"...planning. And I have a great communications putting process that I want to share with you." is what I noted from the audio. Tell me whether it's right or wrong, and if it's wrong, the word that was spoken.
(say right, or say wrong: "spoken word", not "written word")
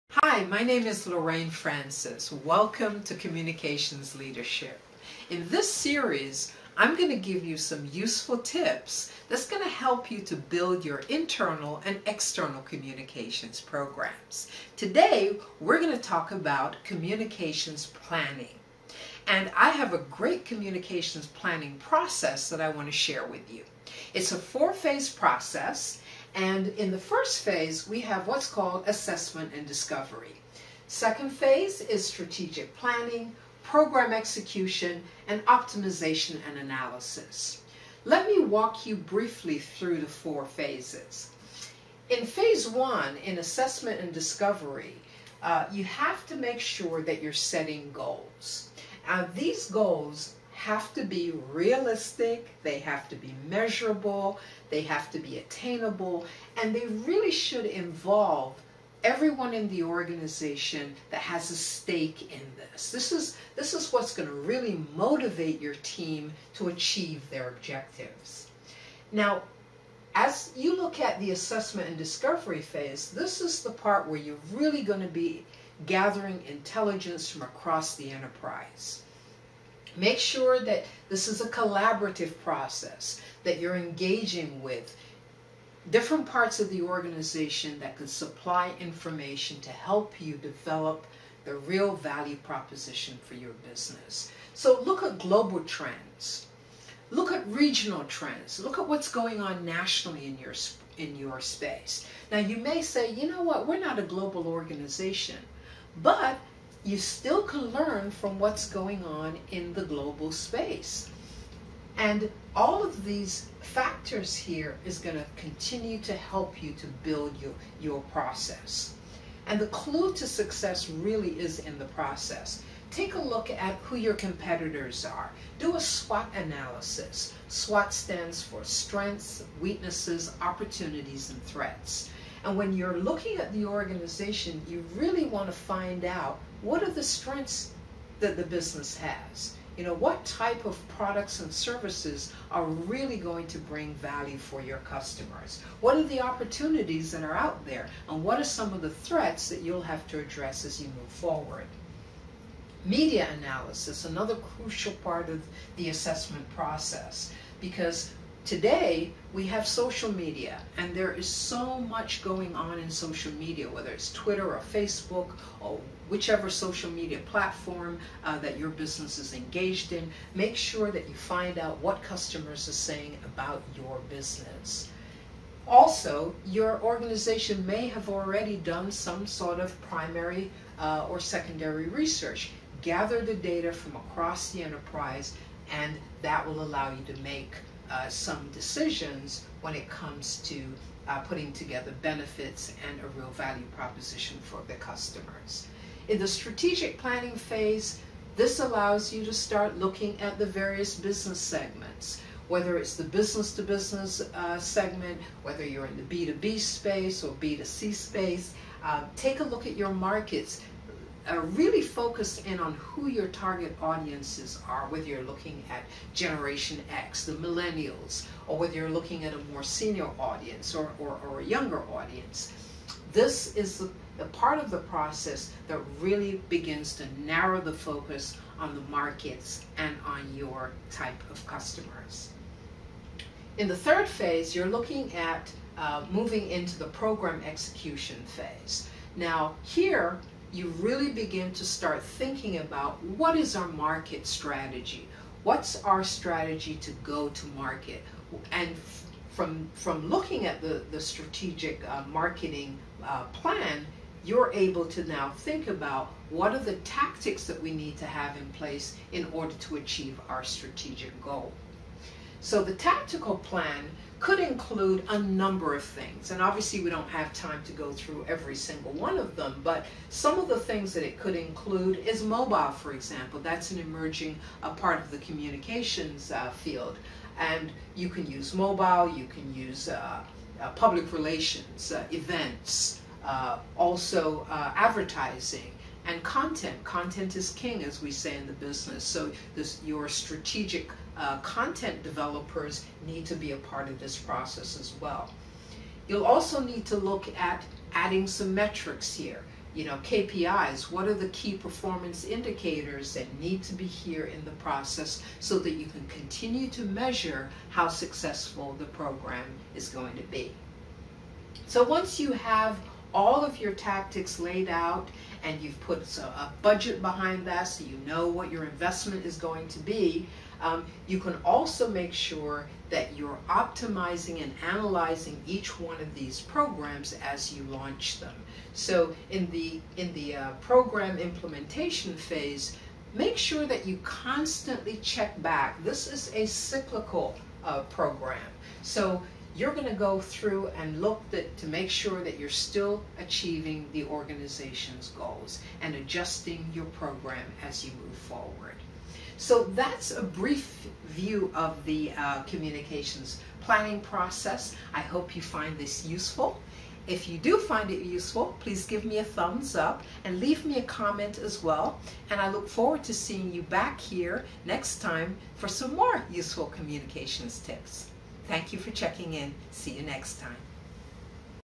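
wrong: "planning", not "putting".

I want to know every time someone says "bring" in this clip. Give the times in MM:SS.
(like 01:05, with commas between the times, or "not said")
02:23.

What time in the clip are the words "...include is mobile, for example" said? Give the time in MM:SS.
04:31.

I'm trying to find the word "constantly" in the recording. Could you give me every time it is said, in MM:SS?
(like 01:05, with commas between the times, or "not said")
05:34.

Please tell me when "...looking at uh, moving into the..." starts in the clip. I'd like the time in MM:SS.
03:54.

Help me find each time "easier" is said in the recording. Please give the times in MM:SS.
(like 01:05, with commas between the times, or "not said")
not said.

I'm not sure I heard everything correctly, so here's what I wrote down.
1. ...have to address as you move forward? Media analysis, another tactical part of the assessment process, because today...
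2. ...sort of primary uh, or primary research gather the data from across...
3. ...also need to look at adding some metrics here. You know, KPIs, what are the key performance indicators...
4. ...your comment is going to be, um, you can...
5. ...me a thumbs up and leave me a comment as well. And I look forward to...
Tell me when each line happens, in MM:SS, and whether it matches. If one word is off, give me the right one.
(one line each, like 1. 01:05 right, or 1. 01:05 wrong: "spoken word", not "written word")
1. 02:29 wrong: "crucial", not "tactical"
2. 02:59 wrong: "secondary", not "primary"
3. 04:56 right
4. 05:18 wrong: "investment", not "comment"
5. 05:59 right.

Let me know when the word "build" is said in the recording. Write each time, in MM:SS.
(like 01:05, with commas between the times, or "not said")
00:10, 01:57.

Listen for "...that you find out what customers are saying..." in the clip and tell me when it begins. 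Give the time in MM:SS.
02:50.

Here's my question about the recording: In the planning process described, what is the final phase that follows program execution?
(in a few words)
Optimization and analysis.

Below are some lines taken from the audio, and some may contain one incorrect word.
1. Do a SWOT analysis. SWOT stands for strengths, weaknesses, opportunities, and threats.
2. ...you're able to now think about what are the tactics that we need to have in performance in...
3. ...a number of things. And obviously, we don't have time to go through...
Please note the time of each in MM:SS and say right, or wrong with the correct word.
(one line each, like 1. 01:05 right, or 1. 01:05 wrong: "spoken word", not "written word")
1. 02:05 right
2. 04:14 wrong: "place", not "performance"
3. 04:25 right.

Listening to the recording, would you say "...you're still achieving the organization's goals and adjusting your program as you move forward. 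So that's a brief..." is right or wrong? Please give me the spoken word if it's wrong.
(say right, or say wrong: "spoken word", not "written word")
right.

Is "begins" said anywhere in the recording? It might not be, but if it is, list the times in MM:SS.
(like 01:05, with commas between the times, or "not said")
03:46, 04:01.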